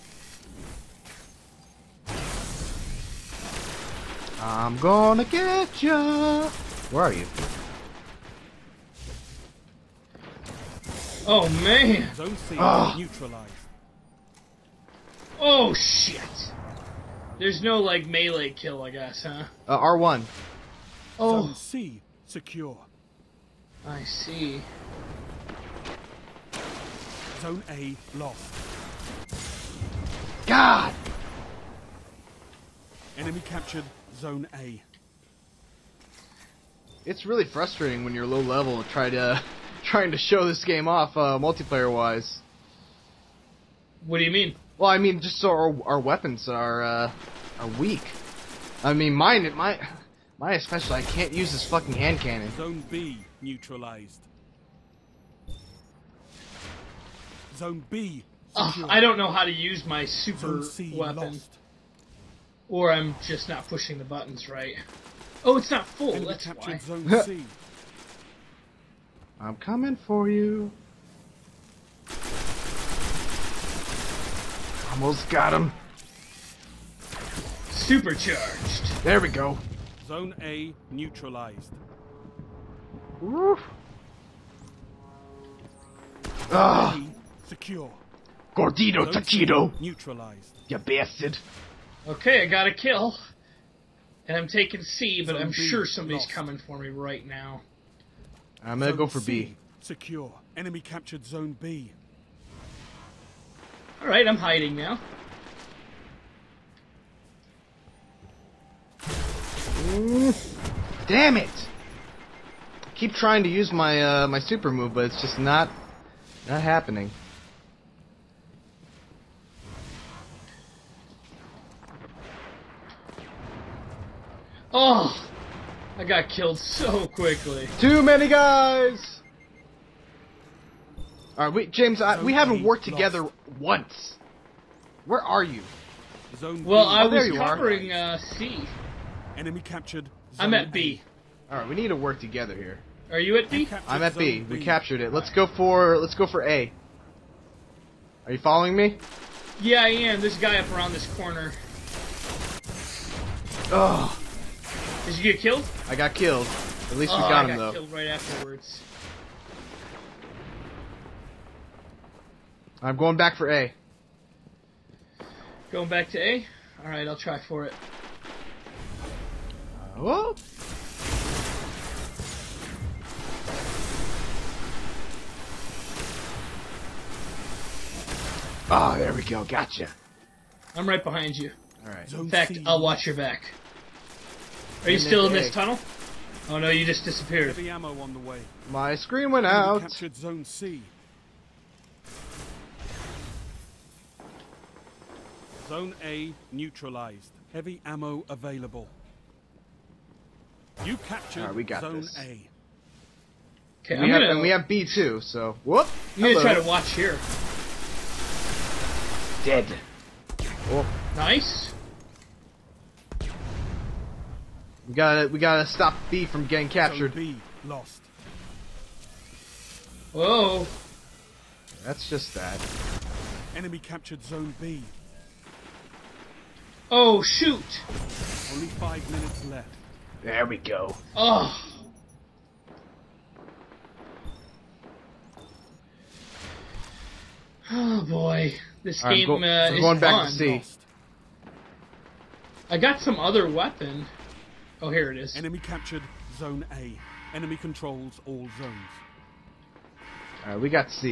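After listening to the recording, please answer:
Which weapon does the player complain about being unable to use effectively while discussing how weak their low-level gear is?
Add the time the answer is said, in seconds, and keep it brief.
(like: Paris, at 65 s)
Hand cannon, at 51 s.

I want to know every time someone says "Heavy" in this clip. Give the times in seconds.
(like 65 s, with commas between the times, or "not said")
187 s, 197 s.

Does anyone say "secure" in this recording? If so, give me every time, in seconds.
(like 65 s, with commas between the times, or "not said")
22 s, 87 s, 99 s.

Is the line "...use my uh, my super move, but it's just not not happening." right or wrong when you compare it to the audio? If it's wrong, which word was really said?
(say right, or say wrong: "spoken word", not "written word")
right.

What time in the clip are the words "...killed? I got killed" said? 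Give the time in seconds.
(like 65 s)
155 s.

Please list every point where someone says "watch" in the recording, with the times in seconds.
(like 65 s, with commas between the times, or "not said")
182 s, 206 s.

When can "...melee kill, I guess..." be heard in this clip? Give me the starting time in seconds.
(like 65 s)
18 s.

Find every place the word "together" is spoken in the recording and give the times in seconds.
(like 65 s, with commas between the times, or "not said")
132 s, 142 s.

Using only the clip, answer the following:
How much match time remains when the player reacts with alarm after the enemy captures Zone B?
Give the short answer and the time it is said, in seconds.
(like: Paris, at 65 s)
5 minutes, at 228 s.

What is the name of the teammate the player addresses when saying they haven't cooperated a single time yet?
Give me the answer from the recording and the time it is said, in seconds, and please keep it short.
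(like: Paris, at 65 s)
James, at 131 s.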